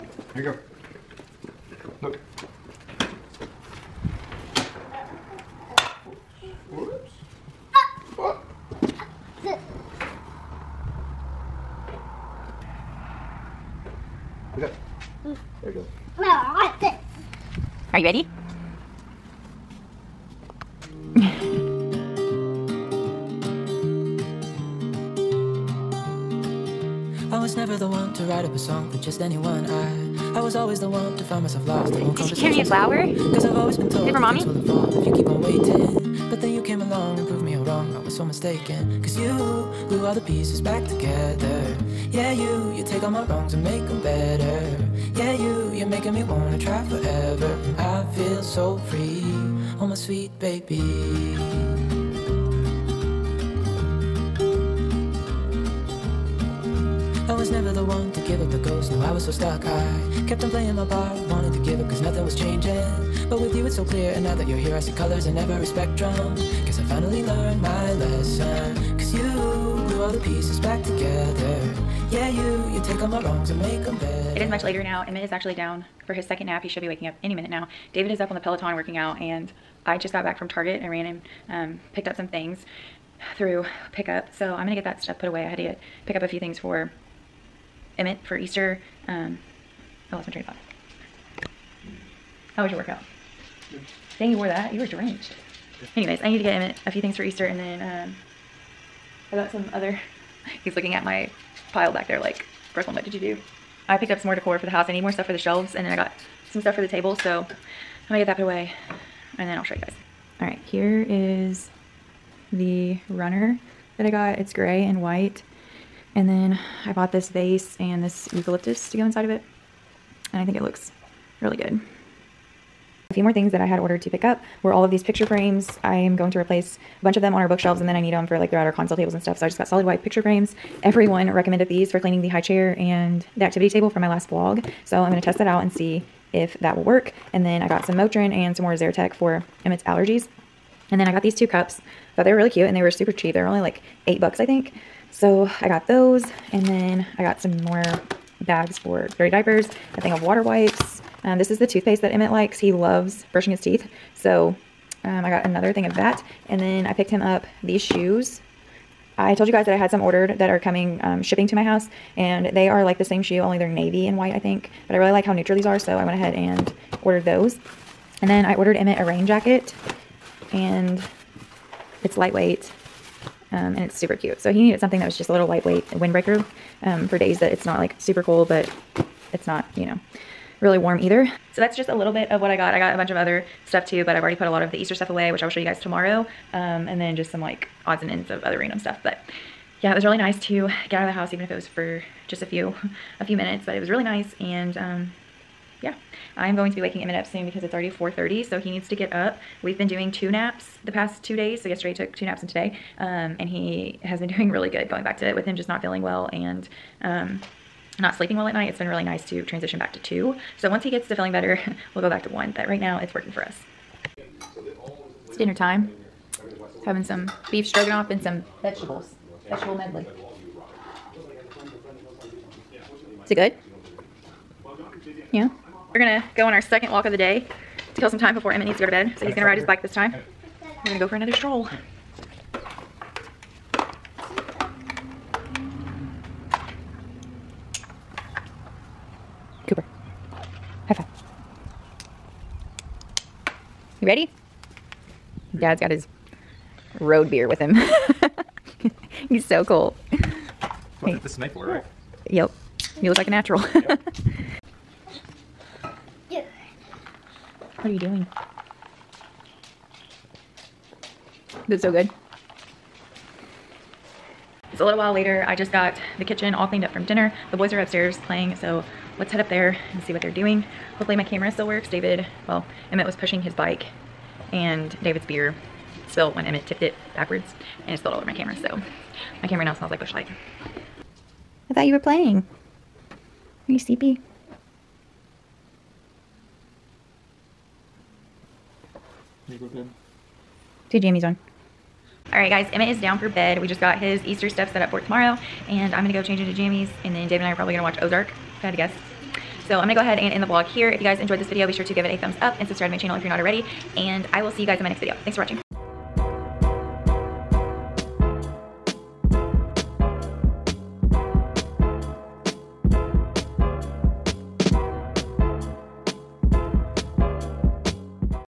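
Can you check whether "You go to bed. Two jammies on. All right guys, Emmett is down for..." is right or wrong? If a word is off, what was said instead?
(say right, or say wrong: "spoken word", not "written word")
right.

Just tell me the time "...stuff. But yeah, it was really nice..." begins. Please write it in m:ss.
3:08.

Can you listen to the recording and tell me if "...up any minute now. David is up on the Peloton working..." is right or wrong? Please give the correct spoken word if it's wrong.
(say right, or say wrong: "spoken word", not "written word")
right.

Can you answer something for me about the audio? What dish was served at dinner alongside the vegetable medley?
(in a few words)
Beef stroganoff.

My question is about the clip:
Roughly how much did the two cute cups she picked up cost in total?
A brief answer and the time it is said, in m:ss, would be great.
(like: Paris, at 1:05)
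8 dollars, at 2:24.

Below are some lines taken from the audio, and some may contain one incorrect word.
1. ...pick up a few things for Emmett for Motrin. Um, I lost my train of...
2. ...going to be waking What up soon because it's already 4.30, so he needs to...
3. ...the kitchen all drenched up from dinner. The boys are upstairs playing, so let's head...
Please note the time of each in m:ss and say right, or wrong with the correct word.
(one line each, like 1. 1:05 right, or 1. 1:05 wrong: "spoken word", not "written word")
1. 1:26 wrong: "Easter", not "Motrin"
2. 3:16 wrong: "Emmett", not "What"
3. 4:26 wrong: "cleaned", not "drenched".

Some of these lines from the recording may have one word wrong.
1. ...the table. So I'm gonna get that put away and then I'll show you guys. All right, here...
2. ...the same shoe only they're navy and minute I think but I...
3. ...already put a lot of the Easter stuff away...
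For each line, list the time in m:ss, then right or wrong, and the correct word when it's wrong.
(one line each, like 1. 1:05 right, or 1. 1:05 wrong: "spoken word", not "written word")
1. 1:46 right
2. 2:42 wrong: "white", not "minute"
3. 3:04 right.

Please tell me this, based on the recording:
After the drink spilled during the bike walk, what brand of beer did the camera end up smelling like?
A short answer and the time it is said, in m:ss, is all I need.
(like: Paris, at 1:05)
Busch Light, at 4:39.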